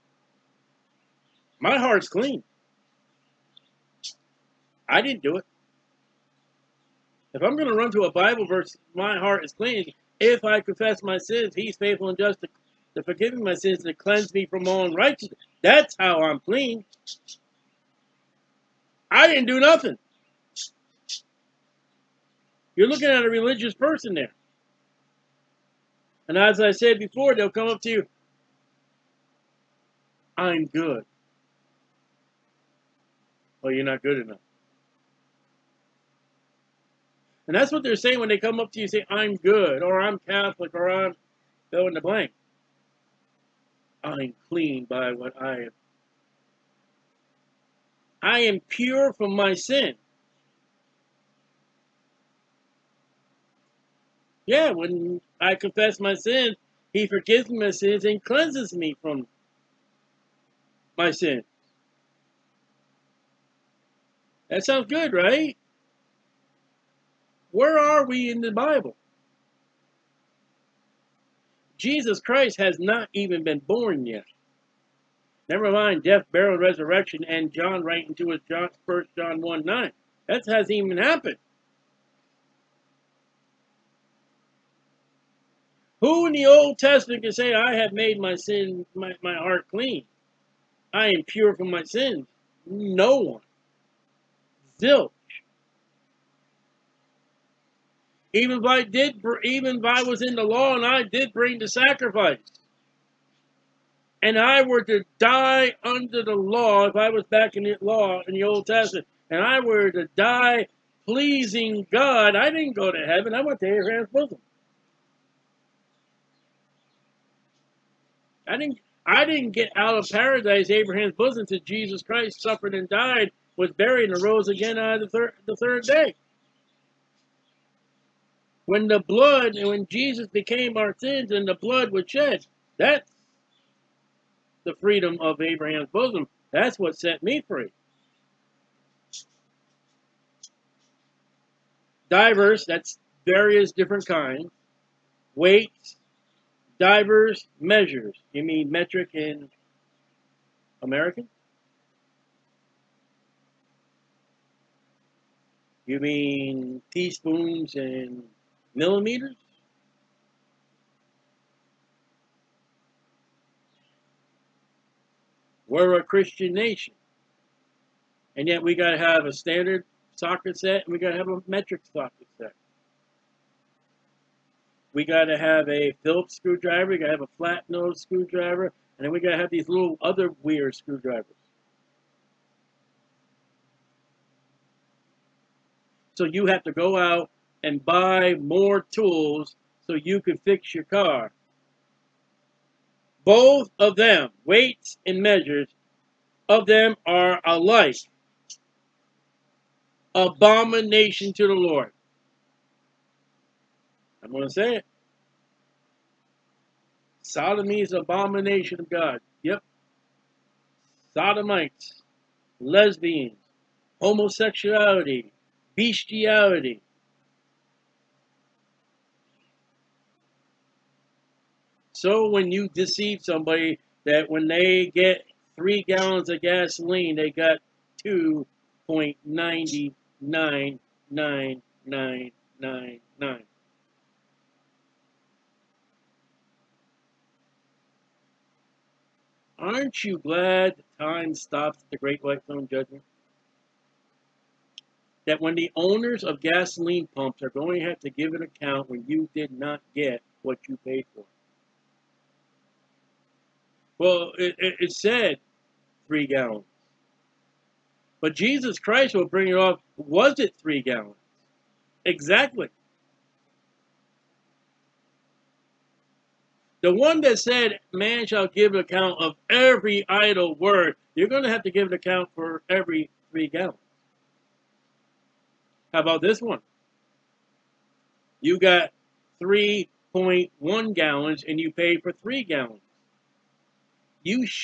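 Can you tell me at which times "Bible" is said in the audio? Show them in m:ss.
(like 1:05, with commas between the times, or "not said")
0:08, 1:08.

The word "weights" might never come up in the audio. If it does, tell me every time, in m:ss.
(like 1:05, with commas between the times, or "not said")
2:25, 3:14.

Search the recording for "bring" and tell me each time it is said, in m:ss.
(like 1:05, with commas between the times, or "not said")
1:41, 4:19.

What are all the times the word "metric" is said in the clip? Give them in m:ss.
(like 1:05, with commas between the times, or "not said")
2:28, 2:51.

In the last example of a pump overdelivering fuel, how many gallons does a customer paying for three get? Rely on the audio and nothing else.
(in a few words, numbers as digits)
3.1 gallons.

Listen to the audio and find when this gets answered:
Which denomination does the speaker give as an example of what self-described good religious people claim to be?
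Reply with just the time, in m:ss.
0:40.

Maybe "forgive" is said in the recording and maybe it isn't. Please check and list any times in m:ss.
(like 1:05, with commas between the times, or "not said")
0:13, 0:57.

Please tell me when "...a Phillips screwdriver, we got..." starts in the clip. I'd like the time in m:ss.
2:55.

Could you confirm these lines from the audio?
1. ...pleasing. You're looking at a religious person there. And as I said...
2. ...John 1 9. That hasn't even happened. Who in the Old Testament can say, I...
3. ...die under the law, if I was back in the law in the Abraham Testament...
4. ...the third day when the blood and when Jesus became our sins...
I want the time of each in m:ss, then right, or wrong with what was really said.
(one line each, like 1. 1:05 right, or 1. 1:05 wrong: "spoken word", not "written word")
1. 0:19 wrong: "nothing", not "pleasing"
2. 1:19 right
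3. 1:45 wrong: "Old", not "Abraham"
4. 2:05 right.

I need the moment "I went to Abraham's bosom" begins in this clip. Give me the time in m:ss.
1:53.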